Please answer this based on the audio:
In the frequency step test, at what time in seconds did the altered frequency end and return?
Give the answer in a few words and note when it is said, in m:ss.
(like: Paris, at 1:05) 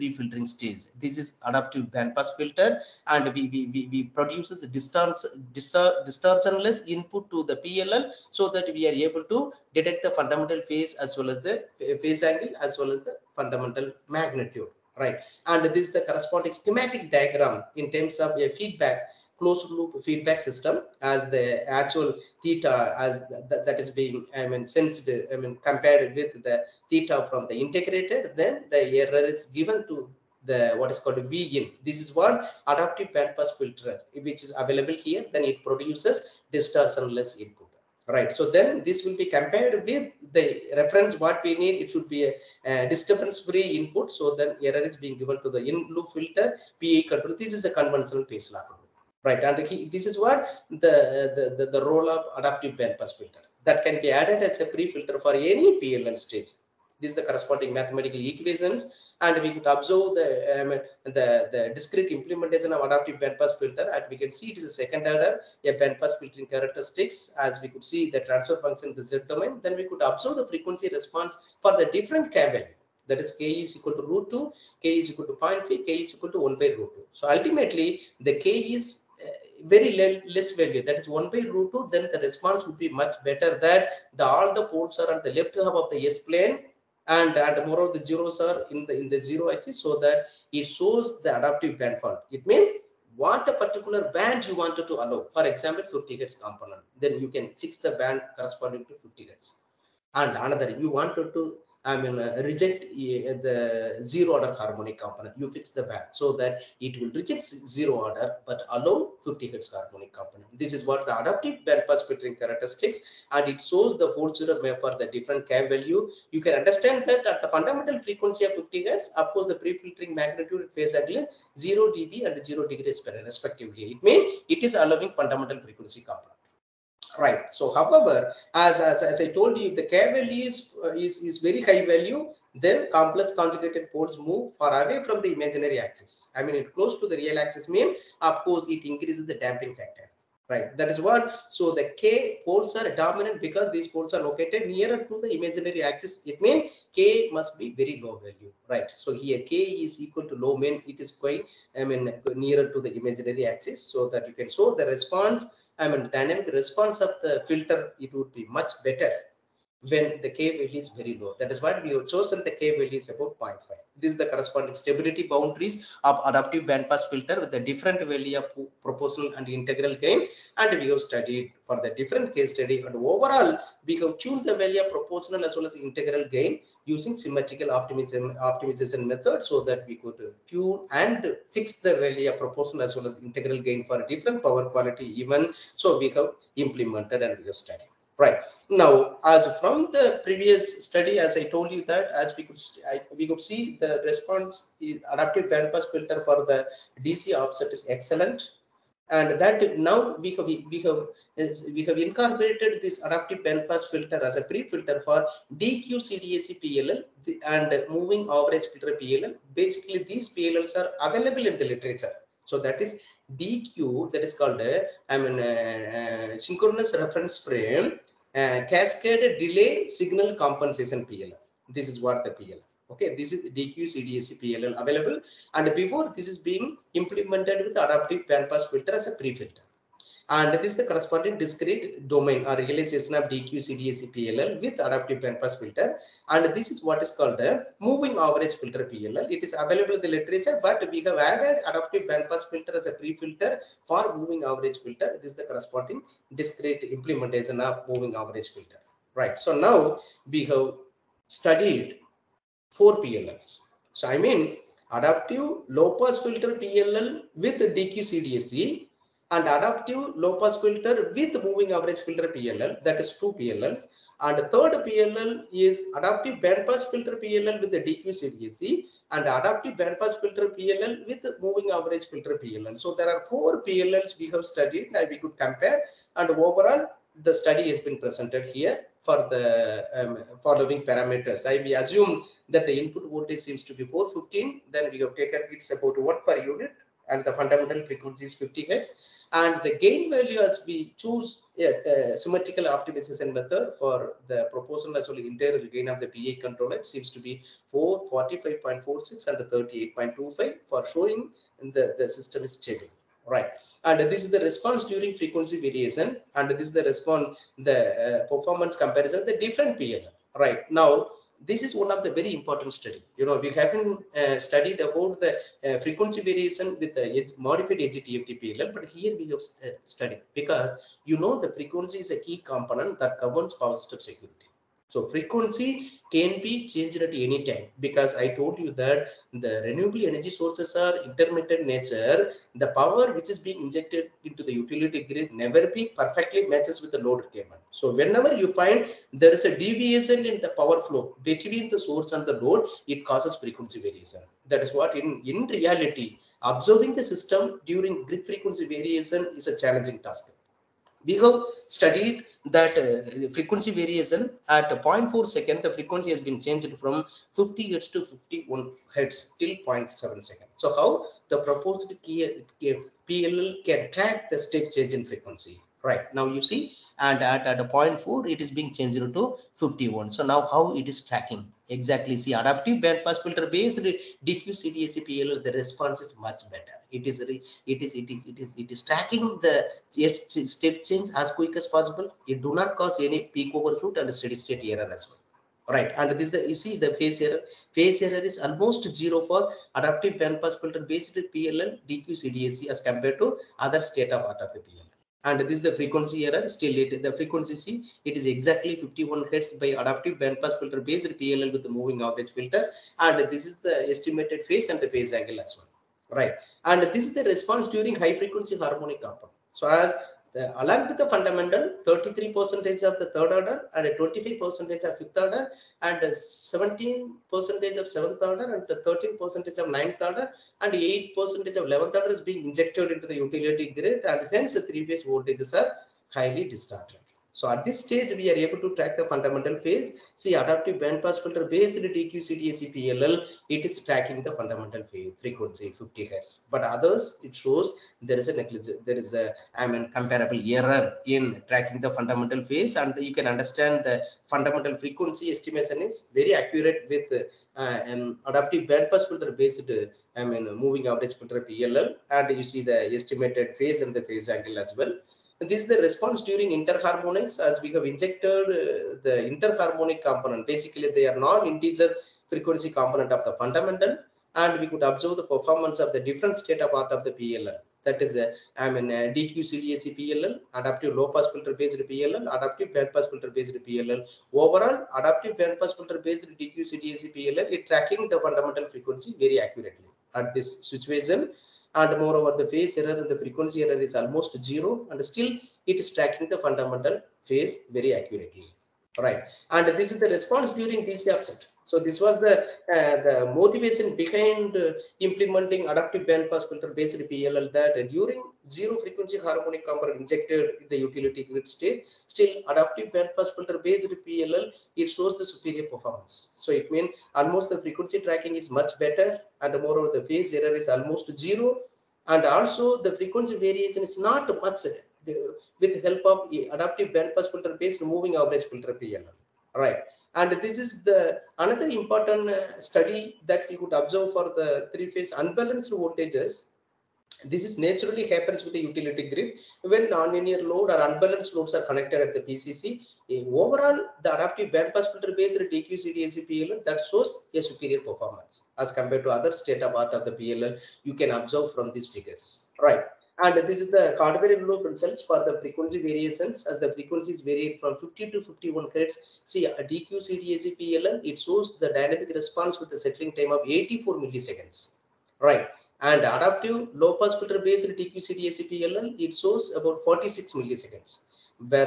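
0.7 second, at 5:59.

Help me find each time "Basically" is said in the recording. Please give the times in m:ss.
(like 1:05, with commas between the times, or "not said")
3:29, 7:40.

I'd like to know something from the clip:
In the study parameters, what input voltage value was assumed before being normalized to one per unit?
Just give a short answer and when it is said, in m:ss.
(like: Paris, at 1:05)
415, at 4:43.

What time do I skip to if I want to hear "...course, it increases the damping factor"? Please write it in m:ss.
2:18.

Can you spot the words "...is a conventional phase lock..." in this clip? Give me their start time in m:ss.
0:47.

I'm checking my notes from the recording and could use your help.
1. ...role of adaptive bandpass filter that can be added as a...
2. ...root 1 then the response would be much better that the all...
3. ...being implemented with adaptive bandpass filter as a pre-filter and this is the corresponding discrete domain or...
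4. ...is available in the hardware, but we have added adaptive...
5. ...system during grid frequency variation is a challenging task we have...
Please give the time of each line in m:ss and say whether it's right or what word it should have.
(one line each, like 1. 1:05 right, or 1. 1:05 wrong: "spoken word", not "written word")
1. 0:51 right
2. 1:21 wrong: "2", not "1"
3. 3:46 right
4. 3:59 wrong: "literature", not "hardware"
5. 5:47 right.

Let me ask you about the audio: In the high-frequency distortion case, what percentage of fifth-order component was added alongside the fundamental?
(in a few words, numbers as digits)
25 percent.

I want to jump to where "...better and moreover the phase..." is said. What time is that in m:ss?
8:28.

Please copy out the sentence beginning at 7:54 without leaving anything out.
Overall, adaptive band pass filter based DQ CDAC PLL is tracking the fundamental frequency very accurately.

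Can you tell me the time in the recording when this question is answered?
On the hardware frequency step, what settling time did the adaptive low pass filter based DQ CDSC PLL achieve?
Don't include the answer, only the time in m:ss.
9:19.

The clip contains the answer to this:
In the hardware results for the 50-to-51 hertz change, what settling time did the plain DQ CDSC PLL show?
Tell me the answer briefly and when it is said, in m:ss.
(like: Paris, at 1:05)
84 milliseconds, at 9:13.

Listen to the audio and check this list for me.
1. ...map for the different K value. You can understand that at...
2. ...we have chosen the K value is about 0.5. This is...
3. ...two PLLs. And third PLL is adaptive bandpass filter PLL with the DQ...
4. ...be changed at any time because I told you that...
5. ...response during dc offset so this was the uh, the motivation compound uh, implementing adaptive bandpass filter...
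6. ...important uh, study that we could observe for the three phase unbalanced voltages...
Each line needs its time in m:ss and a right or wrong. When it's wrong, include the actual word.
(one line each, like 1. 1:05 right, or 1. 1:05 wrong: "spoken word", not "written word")
1. 1:54 right
2. 2:41 right
3. 4:23 right
4. 5:26 right
5. 8:10 wrong: "behind", not "compound"
6. 8:41 right.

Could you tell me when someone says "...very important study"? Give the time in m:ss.
5:12.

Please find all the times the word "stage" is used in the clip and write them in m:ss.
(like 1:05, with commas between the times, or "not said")
0:00, 0:56, 7:07.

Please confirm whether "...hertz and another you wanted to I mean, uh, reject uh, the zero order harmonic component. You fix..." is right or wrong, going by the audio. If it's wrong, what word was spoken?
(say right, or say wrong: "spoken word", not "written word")
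right.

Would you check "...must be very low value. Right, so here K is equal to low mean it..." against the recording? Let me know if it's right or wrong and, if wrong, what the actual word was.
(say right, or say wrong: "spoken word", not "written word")
right.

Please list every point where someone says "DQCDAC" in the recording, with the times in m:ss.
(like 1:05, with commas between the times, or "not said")
8:55, 9:09, 9:17.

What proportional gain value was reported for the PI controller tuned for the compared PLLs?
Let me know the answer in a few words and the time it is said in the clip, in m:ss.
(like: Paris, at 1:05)
45.46, at 4:58.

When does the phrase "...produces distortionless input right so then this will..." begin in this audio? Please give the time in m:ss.
0:35.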